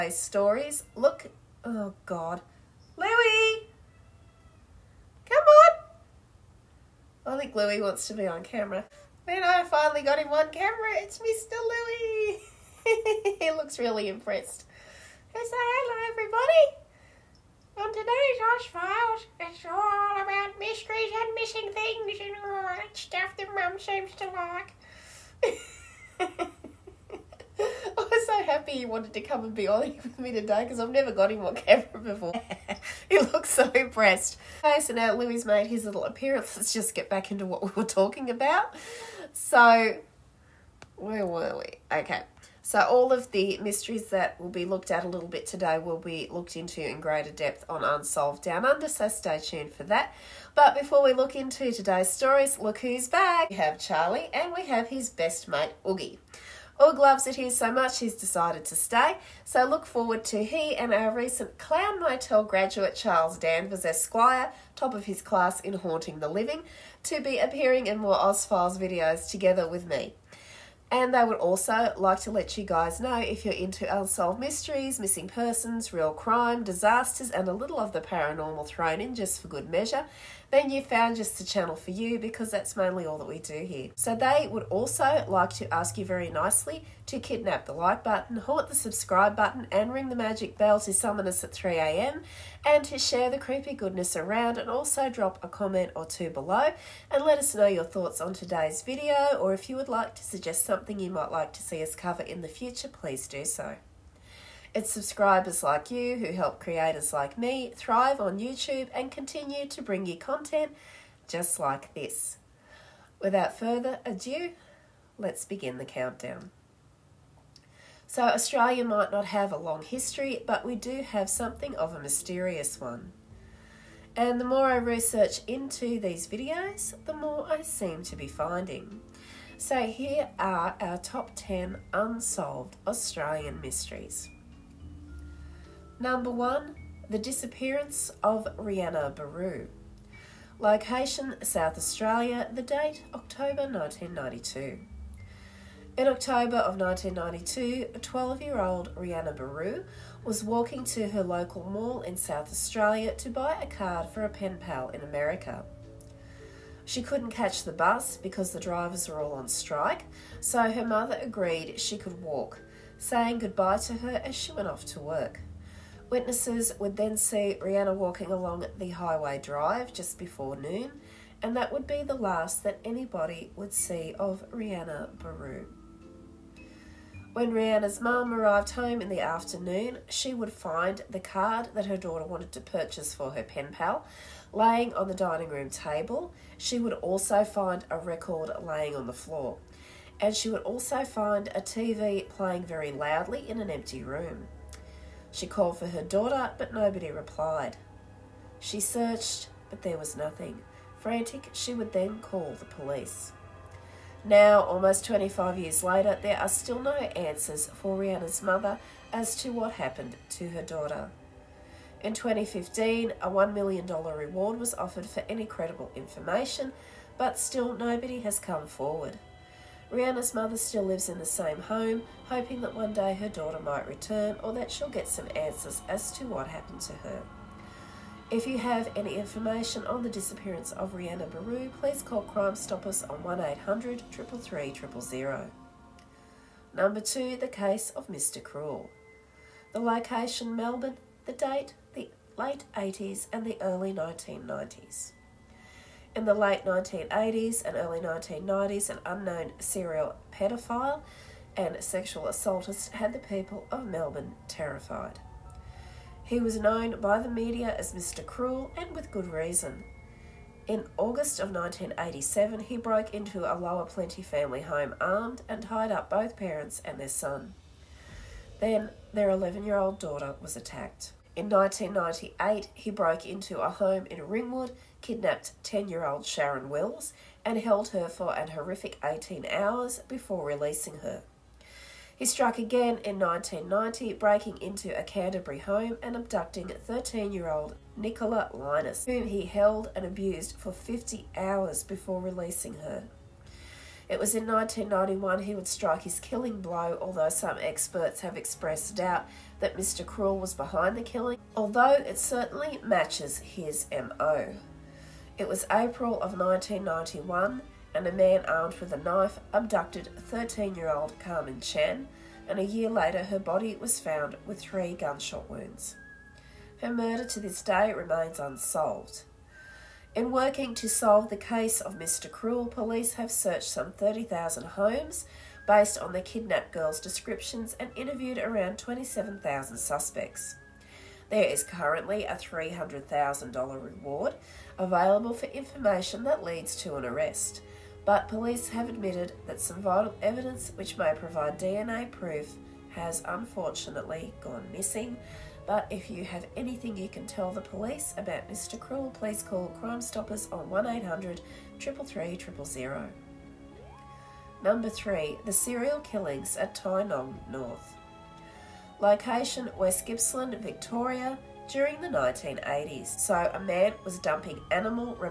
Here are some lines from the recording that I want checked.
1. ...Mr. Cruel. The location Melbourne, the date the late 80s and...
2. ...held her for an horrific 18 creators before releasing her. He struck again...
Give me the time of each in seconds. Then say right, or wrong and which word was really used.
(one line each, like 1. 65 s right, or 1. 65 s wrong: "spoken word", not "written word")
1. 238 s right
2. 277 s wrong: "hours", not "creators".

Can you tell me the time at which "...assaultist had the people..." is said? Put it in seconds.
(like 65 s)
252 s.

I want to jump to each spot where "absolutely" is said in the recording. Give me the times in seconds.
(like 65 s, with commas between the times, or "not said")
not said.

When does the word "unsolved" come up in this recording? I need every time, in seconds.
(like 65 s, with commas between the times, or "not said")
47 s, 73 s, 131 s, 318 s.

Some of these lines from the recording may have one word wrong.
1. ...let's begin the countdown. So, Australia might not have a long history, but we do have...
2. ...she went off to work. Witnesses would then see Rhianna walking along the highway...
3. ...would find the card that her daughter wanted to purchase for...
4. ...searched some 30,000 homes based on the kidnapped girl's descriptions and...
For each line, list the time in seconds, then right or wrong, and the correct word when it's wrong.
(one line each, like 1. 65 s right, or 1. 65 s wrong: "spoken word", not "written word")
1. 115 s right
2. 164 s right
3. 180 s right
4. 323 s right.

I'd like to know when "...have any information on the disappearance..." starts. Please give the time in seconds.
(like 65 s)
228 s.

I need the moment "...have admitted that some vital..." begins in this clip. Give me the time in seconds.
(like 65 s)
338 s.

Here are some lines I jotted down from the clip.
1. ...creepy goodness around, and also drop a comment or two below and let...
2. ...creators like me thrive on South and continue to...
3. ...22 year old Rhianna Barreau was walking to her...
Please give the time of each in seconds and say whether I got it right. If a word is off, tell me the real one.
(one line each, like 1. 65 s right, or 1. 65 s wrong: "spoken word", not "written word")
1. 93 s right
2. 106 s wrong: "YouTube", not "South"
3. 147 s wrong: "12", not "22".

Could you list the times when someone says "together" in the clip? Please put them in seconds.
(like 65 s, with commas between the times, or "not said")
69 s.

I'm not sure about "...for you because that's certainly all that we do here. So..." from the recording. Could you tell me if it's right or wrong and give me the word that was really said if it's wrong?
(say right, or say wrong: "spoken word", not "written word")
wrong: "mainly", not "certainly".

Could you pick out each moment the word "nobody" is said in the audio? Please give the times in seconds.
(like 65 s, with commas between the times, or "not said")
196 s, 217 s.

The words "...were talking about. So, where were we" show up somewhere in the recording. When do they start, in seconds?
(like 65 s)
37 s.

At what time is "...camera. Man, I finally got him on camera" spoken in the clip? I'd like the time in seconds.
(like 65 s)
8 s.